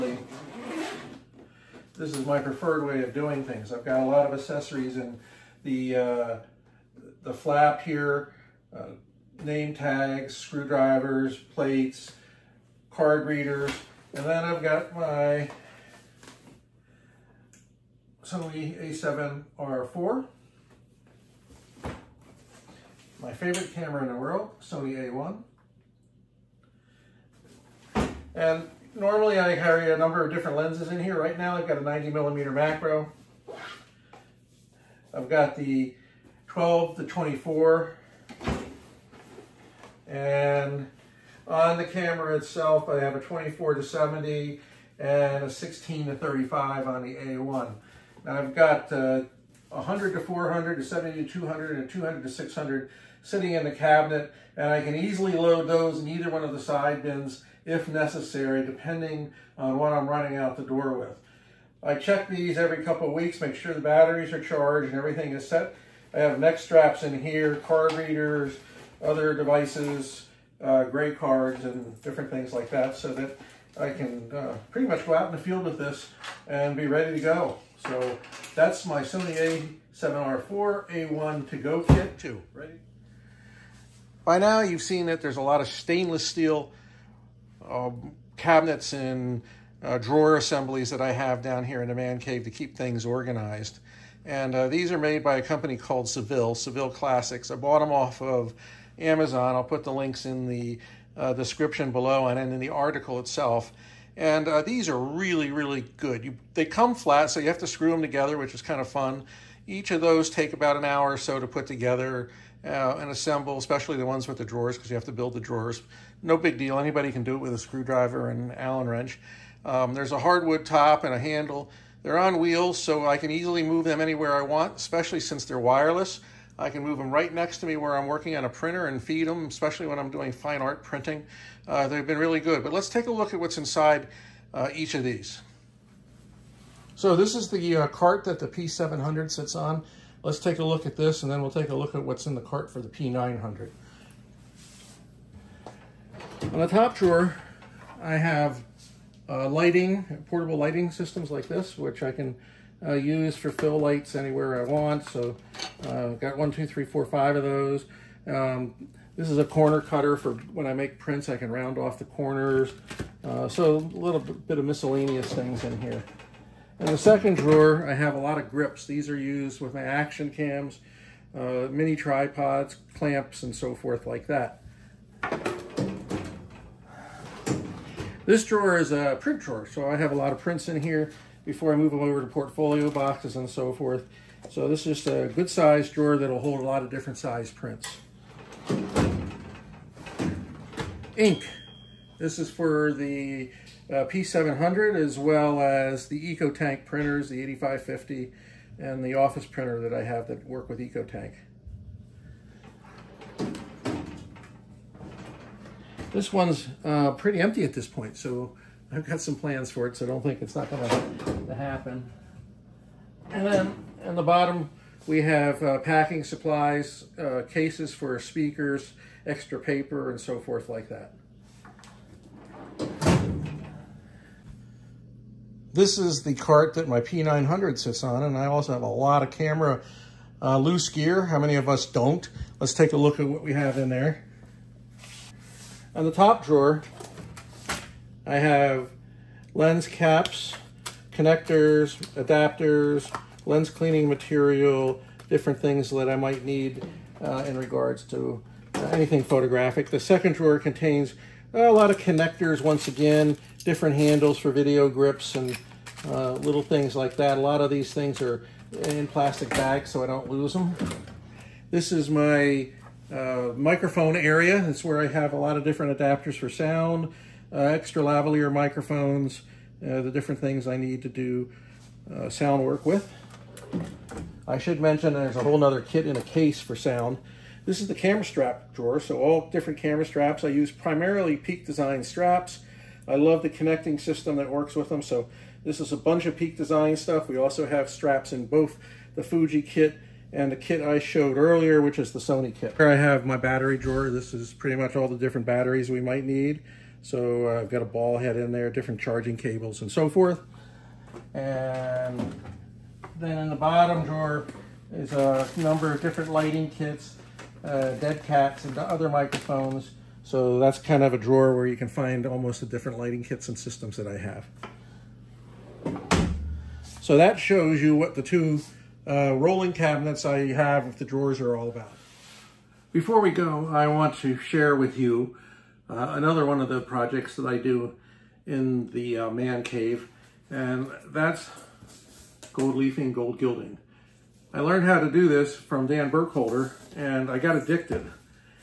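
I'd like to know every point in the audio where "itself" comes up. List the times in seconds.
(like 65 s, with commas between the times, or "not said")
42 s, 103 s.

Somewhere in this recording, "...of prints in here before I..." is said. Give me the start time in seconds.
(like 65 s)
180 s.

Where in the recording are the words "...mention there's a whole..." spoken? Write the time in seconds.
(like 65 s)
274 s.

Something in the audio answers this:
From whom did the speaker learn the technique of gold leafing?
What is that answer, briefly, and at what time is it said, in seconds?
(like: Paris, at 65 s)
Dan Burkholder, at 335 s.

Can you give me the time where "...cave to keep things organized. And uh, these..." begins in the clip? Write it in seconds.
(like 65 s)
92 s.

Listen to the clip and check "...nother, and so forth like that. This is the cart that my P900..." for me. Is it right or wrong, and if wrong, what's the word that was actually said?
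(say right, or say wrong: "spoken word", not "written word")
wrong: "paper", not "nother".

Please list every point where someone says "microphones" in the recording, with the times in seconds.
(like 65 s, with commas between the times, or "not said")
263 s, 268 s, 309 s.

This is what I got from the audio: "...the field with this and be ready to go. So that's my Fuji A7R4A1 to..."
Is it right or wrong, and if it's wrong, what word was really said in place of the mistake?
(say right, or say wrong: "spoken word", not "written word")
wrong: "Sony", not "Fuji".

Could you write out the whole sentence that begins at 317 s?
So that shows you what the two uh, rolling cabinets I have if the drawers are all about.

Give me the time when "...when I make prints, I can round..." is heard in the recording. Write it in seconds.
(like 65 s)
160 s.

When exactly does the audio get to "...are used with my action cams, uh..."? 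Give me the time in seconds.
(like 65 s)
169 s.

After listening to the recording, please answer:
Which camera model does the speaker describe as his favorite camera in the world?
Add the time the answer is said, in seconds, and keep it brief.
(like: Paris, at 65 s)
Sony A1, at 24 s.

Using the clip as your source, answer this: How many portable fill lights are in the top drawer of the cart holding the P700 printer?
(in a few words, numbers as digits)
5.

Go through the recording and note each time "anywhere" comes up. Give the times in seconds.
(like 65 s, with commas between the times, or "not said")
123 s, 154 s.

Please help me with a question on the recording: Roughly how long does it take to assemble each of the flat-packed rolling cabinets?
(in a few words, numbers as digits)
about an hour.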